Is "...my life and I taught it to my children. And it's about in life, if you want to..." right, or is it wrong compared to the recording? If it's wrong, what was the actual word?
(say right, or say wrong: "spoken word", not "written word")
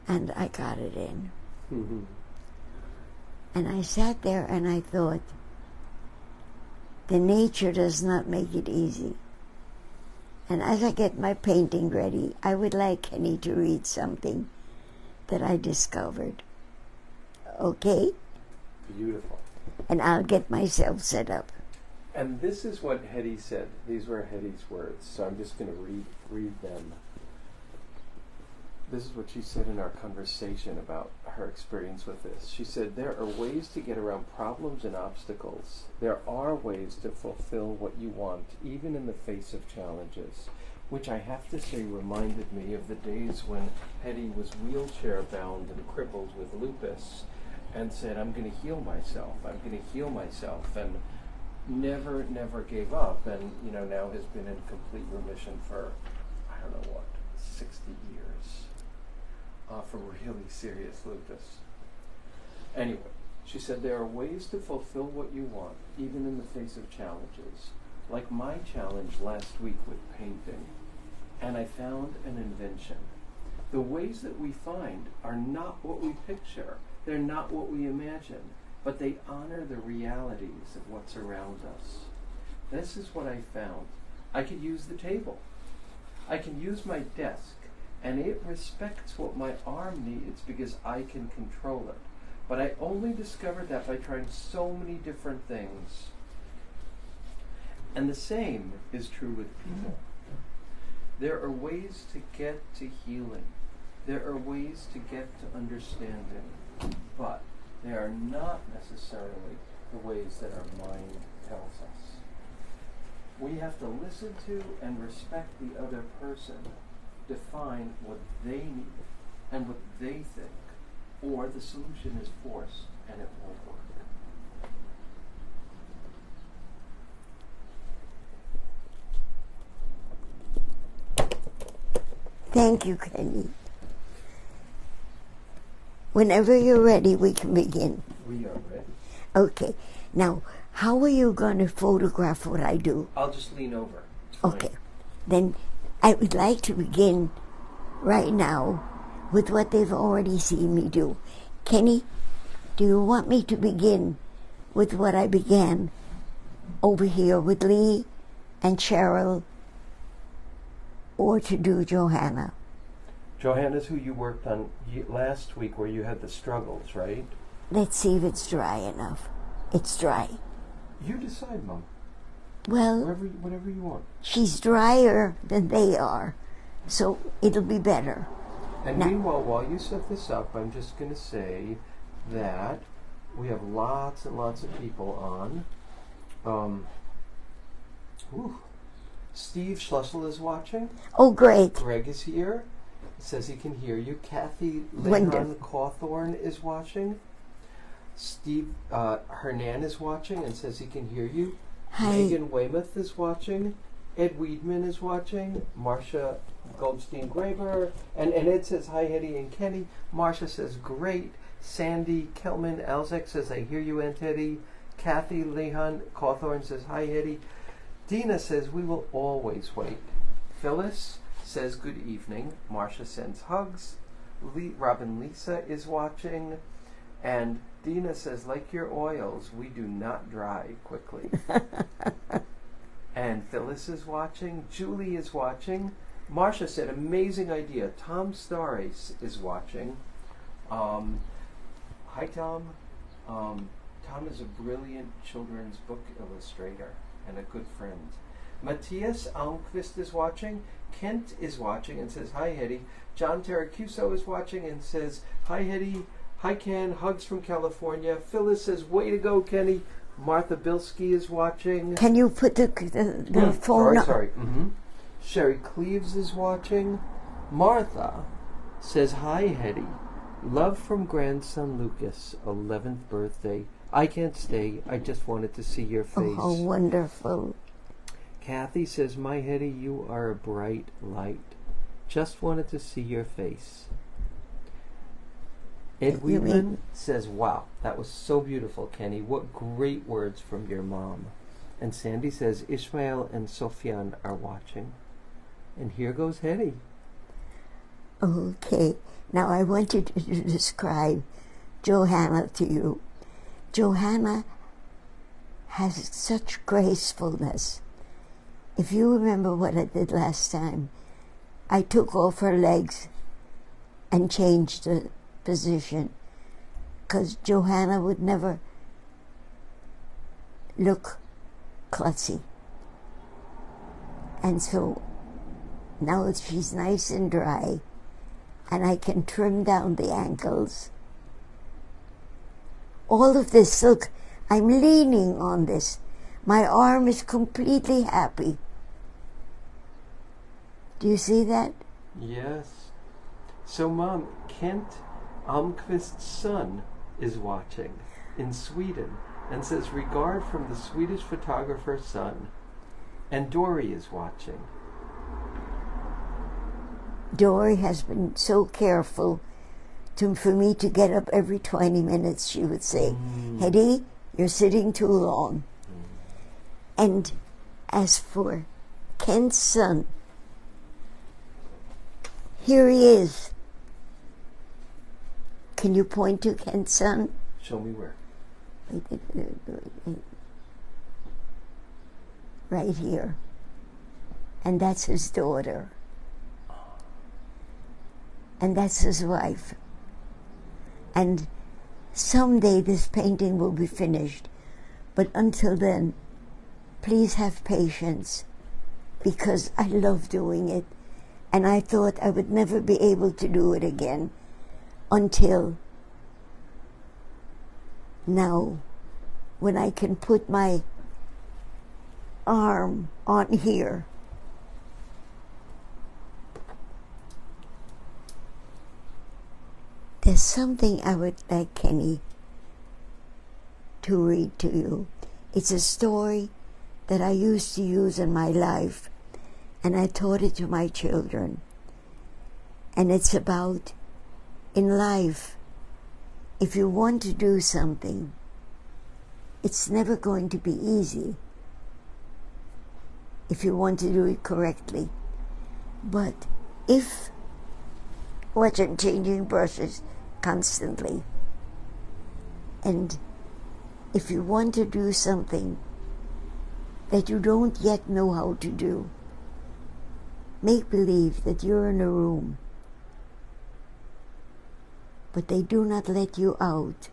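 right.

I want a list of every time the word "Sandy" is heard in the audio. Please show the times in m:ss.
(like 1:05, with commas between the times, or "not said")
3:31, 4:51.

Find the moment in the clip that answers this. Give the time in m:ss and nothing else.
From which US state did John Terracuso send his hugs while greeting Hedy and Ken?
4:17.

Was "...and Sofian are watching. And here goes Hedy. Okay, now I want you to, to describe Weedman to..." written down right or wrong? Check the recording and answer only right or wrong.
wrong.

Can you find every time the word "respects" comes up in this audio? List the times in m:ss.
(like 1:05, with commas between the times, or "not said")
1:28, 1:55.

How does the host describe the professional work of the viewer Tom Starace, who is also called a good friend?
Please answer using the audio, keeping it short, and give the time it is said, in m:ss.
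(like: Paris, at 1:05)
children's book illustrator, at 4:05.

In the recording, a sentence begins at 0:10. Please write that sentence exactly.
And as I get my painting ready, I would like Kenny to read something that I discovered.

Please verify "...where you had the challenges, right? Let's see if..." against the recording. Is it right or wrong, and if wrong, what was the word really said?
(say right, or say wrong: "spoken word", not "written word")
wrong: "struggles", not "challenges".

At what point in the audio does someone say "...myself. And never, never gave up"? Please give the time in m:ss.
0:50.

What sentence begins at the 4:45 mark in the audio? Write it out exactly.
Ed Wheatland says, Wow, that was so beautiful, Kenny.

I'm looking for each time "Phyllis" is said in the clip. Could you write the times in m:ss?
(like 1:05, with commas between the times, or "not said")
3:40, 3:53, 4:18.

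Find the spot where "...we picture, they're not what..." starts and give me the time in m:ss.
1:16.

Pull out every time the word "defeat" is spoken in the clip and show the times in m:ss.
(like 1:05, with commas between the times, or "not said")
not said.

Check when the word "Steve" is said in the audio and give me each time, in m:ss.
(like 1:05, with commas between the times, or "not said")
3:09, 3:18.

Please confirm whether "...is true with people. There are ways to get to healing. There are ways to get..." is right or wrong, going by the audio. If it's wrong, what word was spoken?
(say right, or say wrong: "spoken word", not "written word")
right.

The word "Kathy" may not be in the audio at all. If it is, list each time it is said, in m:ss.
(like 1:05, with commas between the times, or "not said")
3:14, 3:34, 4:38.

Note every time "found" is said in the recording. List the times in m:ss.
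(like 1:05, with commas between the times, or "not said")
1:11, 1:23.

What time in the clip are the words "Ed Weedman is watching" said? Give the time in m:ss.
3:24.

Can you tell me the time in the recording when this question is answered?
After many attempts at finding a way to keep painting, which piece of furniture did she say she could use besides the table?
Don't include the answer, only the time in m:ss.
1:26.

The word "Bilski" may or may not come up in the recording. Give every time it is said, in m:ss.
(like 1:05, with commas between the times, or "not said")
4:20.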